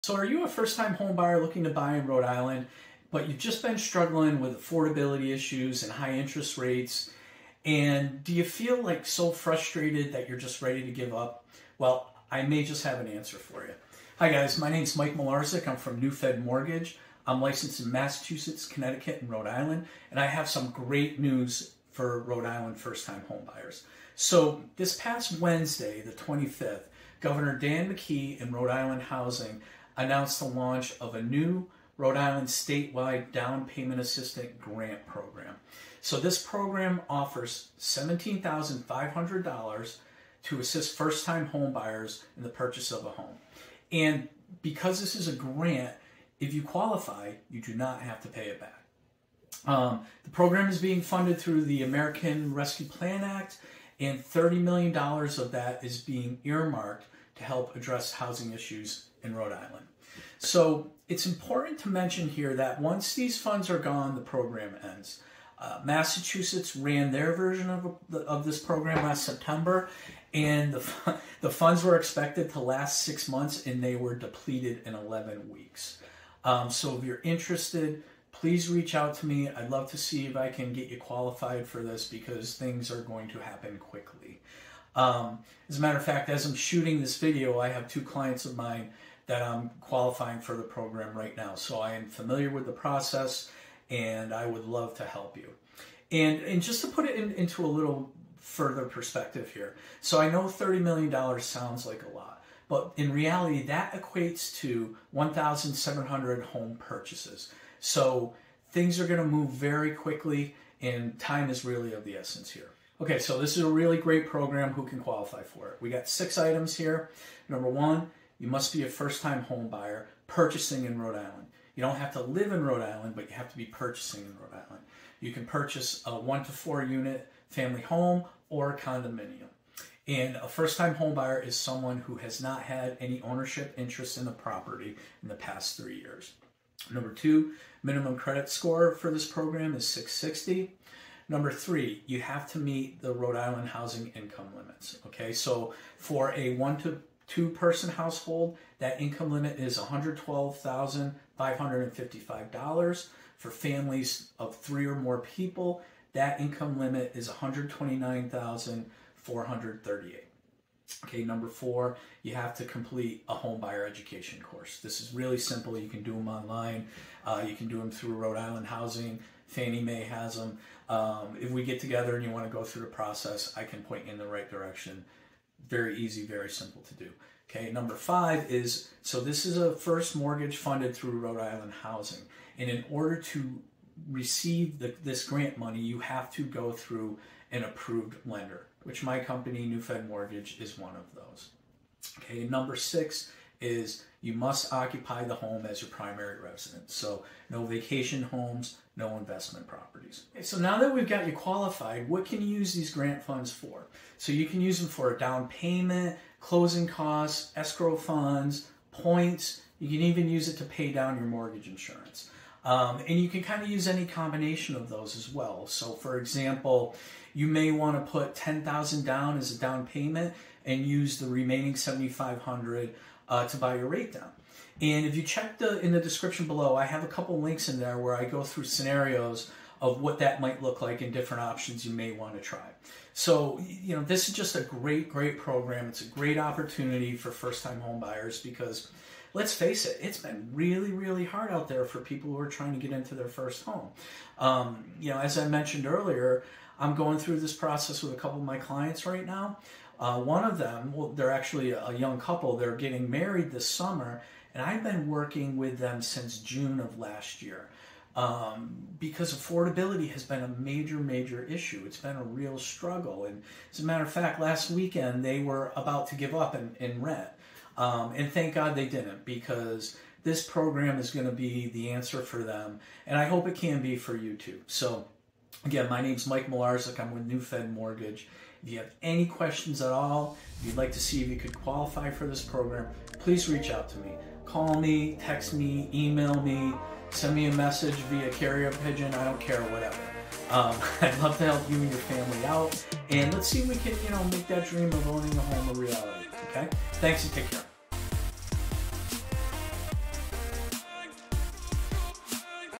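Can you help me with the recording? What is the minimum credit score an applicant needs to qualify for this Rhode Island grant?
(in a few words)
660.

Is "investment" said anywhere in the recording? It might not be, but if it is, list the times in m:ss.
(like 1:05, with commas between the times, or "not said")
3:19.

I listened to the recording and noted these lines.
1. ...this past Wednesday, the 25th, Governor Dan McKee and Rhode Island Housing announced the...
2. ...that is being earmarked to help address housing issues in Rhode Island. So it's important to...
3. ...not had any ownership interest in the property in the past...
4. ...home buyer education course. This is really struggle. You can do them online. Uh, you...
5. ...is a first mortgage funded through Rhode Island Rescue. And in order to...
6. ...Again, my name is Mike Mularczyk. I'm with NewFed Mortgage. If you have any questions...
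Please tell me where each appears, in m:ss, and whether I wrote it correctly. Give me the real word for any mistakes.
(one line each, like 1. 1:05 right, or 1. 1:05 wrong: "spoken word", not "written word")
1. 0:24 right
2. 0:55 right
3. 2:12 right
4. 2:43 wrong: "simple", not "struggle"
5. 2:59 wrong: "Housing", not "Rescue"
6. 4:35 right.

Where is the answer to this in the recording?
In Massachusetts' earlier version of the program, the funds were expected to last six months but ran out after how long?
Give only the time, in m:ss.
1:14.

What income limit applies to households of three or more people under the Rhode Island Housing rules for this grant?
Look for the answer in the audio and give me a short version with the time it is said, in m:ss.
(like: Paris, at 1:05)
$129,438, at 2:37.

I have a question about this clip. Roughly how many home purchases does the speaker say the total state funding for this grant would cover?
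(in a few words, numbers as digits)
1,700.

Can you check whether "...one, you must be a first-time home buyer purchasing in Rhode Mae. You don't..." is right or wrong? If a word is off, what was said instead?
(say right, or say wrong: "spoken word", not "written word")
wrong: "Island", not "Mae".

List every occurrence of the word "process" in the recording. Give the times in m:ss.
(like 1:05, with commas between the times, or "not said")
1:32, 2:52, 4:07.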